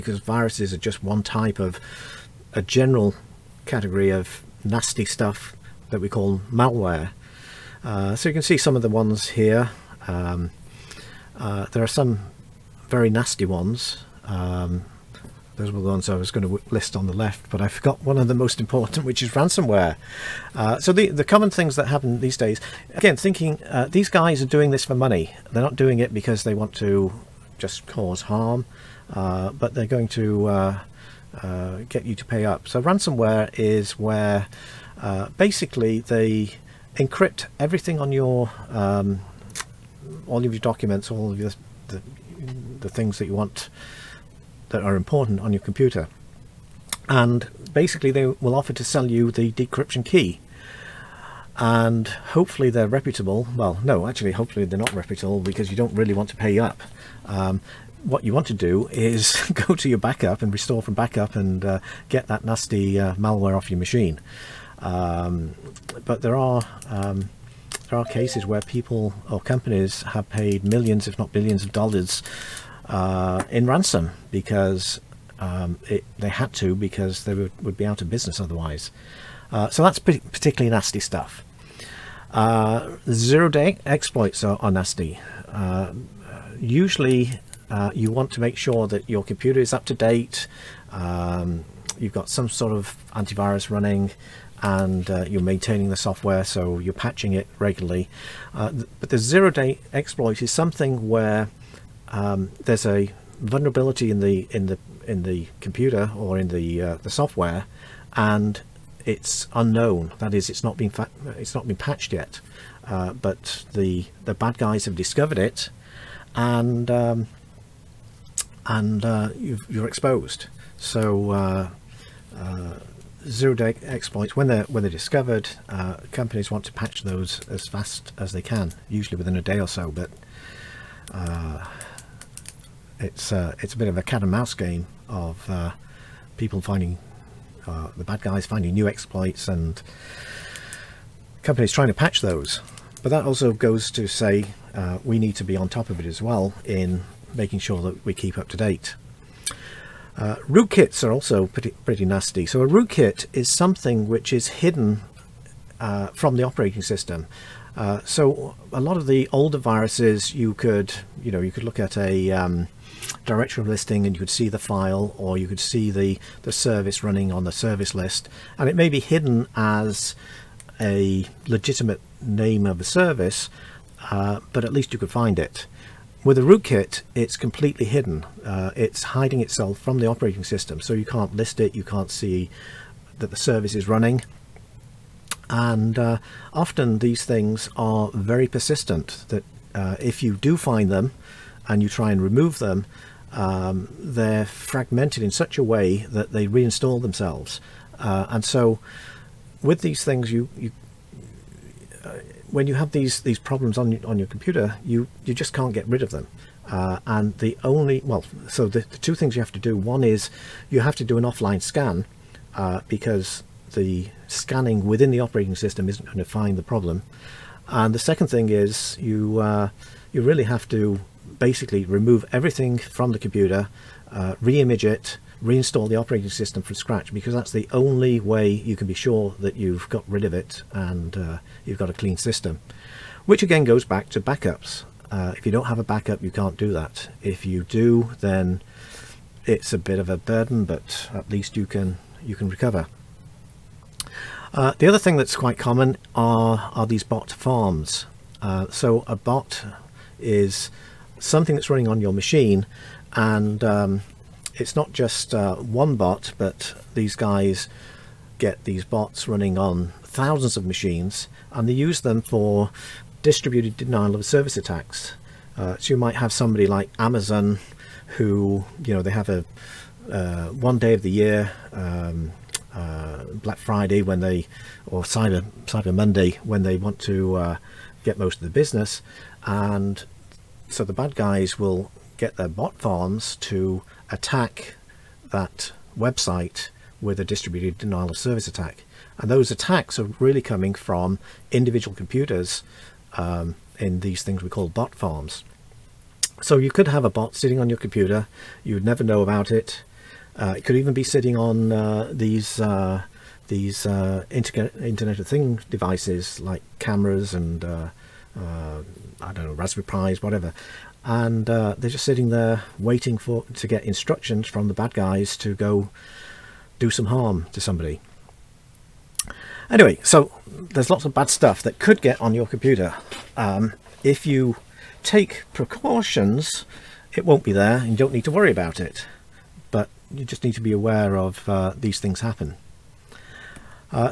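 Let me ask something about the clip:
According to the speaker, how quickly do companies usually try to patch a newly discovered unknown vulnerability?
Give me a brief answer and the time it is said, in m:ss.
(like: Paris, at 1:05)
Within a day, at 2:09.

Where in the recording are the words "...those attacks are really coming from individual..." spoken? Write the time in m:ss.
4:49.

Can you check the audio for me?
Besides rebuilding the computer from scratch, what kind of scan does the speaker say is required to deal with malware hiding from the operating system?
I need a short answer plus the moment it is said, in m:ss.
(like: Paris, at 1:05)
Offline scan, at 3:31.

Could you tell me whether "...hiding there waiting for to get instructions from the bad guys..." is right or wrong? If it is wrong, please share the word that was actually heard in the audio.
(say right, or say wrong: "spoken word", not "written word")
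wrong: "sitting", not "hiding".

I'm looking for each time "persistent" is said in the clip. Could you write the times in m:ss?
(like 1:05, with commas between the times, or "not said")
3:08.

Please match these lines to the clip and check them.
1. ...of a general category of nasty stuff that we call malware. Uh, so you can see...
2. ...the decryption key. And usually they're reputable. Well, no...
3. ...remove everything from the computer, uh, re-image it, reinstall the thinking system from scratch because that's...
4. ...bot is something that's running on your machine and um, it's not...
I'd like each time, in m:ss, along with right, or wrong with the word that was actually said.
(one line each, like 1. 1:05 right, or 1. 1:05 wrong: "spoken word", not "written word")
1. 0:01 right
2. 0:49 wrong: "hopefully", not "usually"
3. 3:41 wrong: "operating", not "thinking"
4. 4:09 right.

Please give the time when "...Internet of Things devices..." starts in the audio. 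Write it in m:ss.
5:04.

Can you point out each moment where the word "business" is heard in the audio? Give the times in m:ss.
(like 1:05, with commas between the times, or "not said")
1:18, 4:38.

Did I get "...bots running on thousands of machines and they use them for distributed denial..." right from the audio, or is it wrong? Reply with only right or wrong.
right.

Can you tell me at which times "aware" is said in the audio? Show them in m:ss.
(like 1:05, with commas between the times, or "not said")
5:30.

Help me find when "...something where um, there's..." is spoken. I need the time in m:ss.
1:40.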